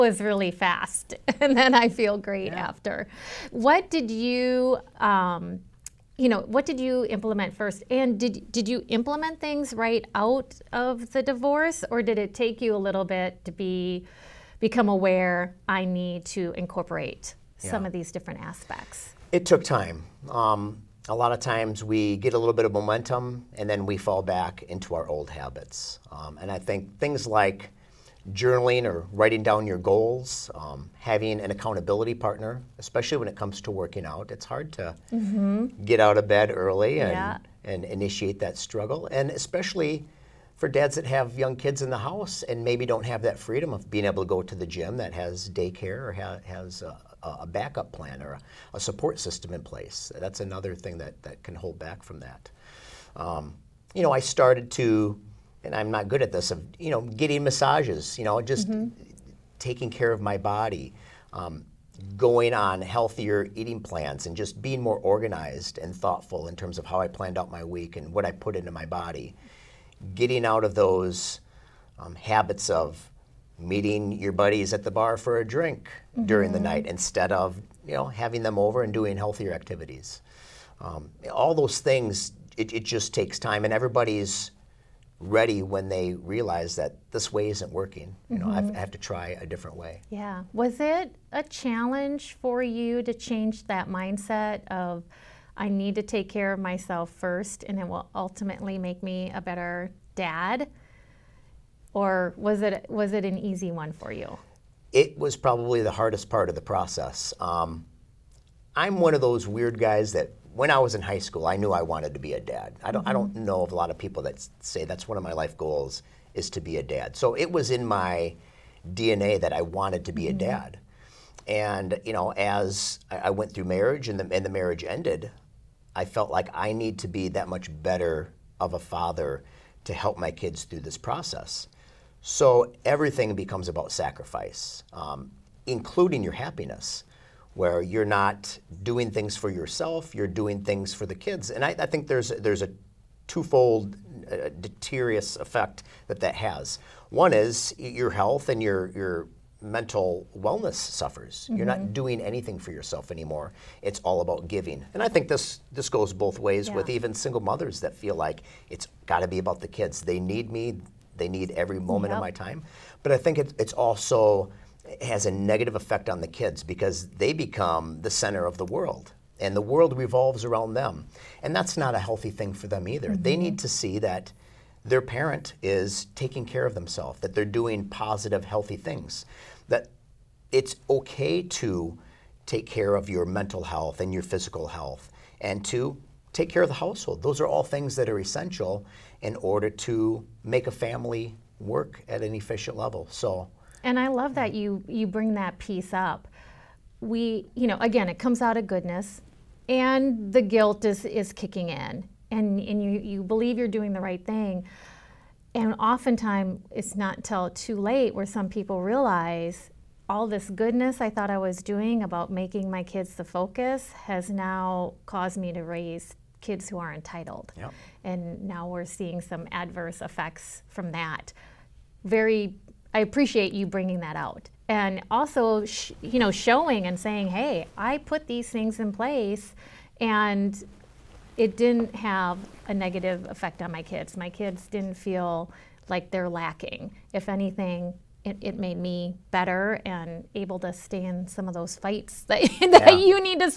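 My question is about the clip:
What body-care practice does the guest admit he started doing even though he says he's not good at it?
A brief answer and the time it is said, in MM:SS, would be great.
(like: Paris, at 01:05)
Massages, at 00:57.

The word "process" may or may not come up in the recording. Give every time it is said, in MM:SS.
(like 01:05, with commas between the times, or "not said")
01:46, 02:10.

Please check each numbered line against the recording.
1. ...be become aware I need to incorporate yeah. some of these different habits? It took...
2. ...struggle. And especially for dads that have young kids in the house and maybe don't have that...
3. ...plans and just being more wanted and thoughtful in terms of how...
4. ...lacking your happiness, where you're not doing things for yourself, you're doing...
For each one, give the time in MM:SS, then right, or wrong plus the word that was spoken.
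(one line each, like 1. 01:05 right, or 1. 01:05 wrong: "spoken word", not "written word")
1. 00:13 wrong: "aspects", not "habits"
2. 00:38 right
3. 01:03 wrong: "organized", not "wanted"
4. 02:15 wrong: "including", not "lacking".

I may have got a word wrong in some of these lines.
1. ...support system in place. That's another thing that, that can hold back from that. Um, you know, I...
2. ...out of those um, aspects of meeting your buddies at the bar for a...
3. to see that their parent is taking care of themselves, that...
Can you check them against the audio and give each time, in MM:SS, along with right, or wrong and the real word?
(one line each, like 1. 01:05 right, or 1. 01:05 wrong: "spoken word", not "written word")
1. 00:48 right
2. 01:10 wrong: "habits", not "aspects"
3. 02:53 right.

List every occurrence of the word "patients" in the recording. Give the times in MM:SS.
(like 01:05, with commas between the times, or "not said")
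not said.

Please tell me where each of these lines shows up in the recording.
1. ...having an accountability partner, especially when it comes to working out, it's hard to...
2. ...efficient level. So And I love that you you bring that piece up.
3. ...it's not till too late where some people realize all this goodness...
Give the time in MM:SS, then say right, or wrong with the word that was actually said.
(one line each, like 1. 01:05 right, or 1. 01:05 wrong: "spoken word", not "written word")
1. 00:30 right
2. 03:12 right
3. 03:26 right.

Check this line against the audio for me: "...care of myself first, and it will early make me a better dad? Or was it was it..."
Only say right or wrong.
wrong.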